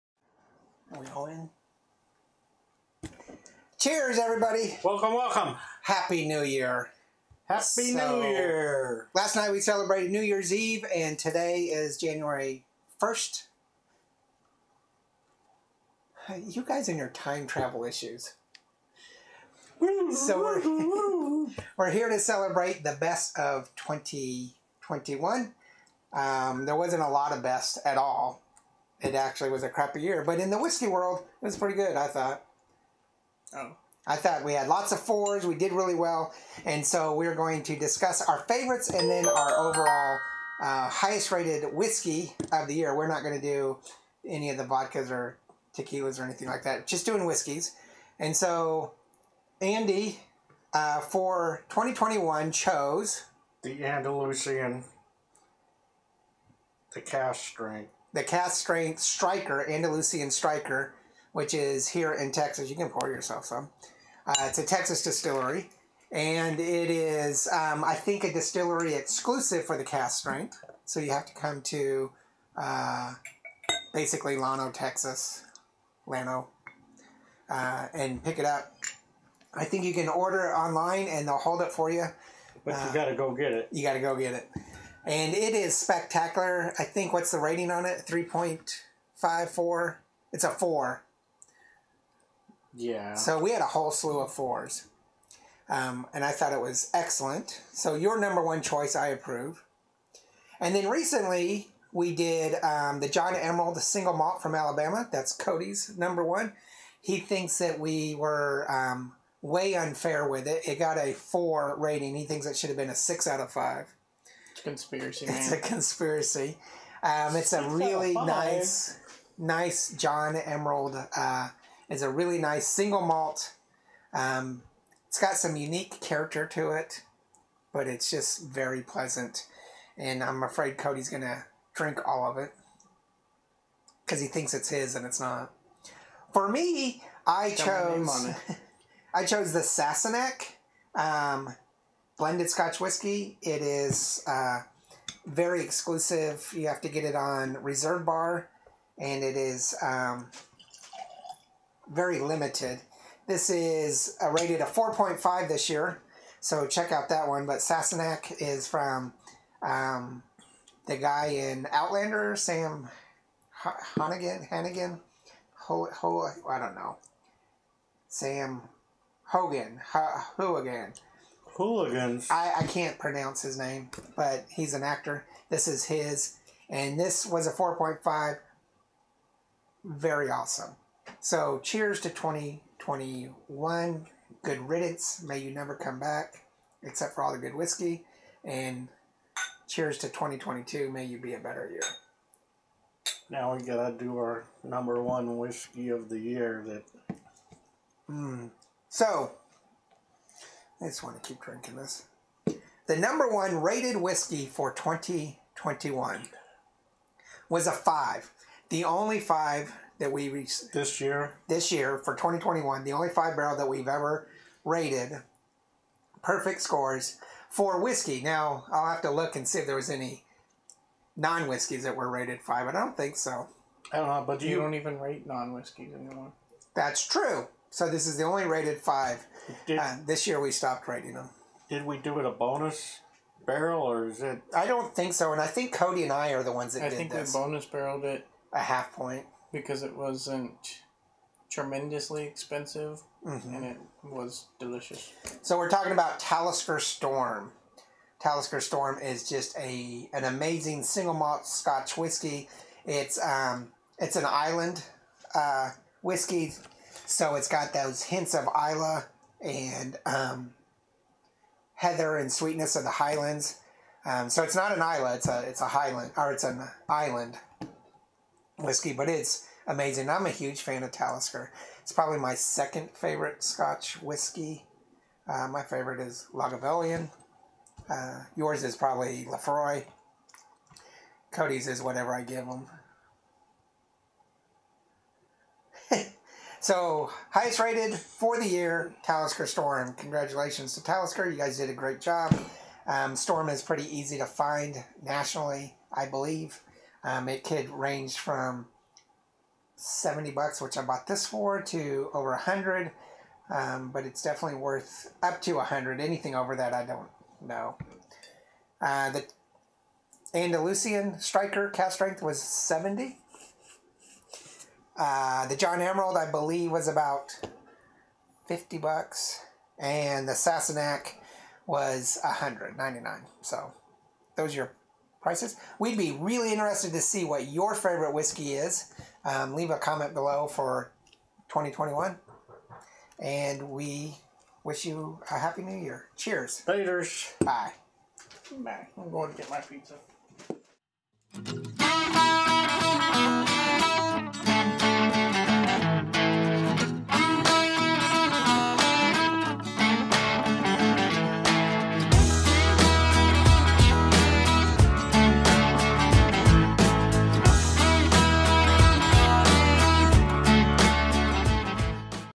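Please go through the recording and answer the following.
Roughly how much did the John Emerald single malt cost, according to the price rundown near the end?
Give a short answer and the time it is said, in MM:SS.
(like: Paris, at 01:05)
$50, at 05:18.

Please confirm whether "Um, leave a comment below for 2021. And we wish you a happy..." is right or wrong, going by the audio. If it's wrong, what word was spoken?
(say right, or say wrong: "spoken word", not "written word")
right.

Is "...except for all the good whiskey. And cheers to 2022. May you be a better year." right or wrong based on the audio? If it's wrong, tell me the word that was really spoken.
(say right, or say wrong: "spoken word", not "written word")
right.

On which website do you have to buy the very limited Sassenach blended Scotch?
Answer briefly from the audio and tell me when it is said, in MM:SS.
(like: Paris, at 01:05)
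Reserve Bar, at 02:27.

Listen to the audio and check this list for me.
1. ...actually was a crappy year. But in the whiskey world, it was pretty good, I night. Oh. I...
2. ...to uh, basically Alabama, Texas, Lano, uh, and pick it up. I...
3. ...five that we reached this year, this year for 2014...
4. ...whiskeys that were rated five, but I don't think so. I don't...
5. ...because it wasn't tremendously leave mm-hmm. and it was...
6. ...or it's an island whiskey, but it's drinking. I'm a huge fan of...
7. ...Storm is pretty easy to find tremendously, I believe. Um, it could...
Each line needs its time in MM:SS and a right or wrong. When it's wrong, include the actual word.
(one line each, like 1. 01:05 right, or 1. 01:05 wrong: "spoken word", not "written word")
1. 00:29 wrong: "thought", not "night"
2. 01:11 wrong: "Lano", not "Alabama"
3. 03:29 wrong: "2021", not "2014"
4. 03:41 right
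5. 03:59 wrong: "expensive", not "leave"
6. 04:26 wrong: "amazing", not "drinking"
7. 04:53 wrong: "nationally", not "tremendously".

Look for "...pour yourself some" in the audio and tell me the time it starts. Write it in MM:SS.
01:02.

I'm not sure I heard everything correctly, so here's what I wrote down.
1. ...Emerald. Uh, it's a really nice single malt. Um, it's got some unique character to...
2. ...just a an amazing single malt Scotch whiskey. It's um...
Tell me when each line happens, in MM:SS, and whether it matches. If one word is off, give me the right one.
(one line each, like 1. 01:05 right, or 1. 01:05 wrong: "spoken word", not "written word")
1. 02:00 right
2. 04:09 right.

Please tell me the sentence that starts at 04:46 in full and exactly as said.
So, highest rated for the year, Talisker Storm.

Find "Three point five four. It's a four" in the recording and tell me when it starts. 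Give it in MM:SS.
01:28.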